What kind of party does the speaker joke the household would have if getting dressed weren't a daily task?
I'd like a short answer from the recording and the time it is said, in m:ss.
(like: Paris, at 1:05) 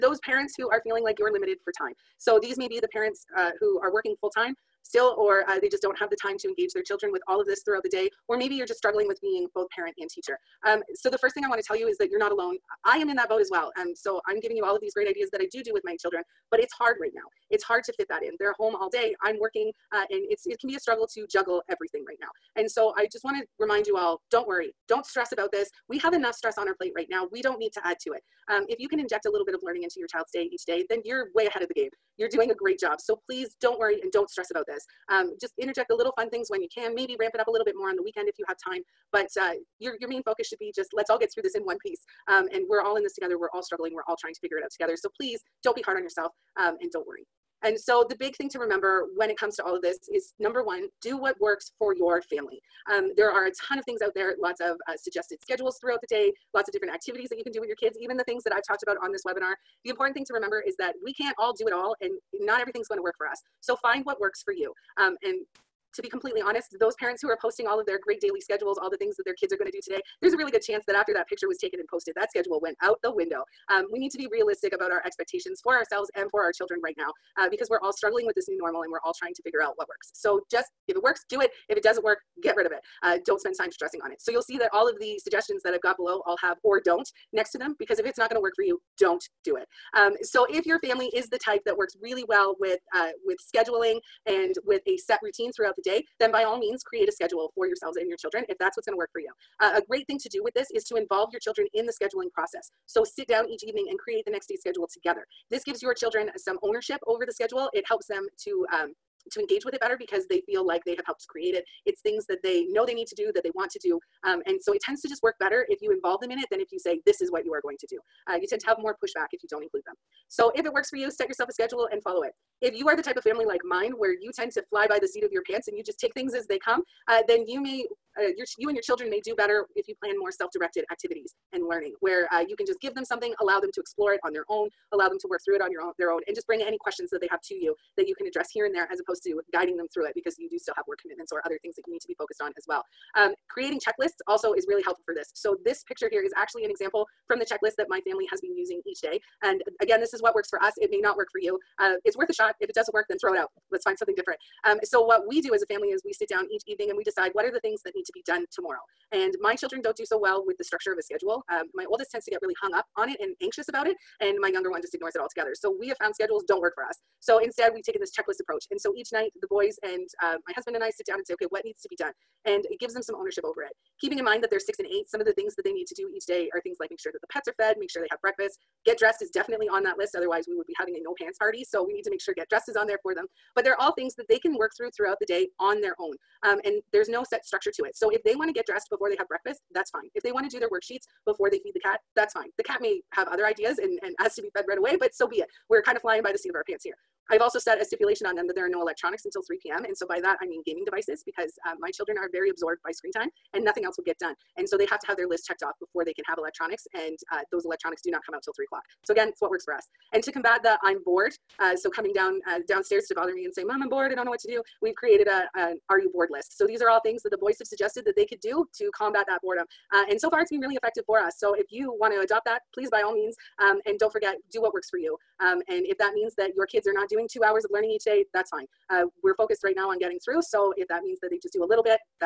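No pants party, at 3:01.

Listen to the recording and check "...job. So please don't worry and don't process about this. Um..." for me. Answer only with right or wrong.
wrong.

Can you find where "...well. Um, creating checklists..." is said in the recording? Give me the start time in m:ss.
2:22.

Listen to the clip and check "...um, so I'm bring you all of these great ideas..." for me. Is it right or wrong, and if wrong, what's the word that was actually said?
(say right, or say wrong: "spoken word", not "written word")
wrong: "giving", not "bring".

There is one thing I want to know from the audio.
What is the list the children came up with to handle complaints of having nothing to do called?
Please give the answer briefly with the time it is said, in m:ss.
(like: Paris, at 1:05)
Are you bored? list, at 3:35.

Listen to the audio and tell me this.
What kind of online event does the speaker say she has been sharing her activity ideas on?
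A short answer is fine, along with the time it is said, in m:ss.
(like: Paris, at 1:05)
Webinar, at 0:59.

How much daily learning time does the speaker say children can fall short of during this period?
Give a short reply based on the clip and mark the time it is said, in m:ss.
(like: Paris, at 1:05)
2 hours, at 3:47.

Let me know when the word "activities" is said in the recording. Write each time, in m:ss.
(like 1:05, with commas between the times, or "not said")
0:56, 2:10.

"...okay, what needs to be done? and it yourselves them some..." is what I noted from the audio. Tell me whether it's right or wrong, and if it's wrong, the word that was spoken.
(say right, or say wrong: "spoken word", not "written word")
wrong: "gives", not "yourselves".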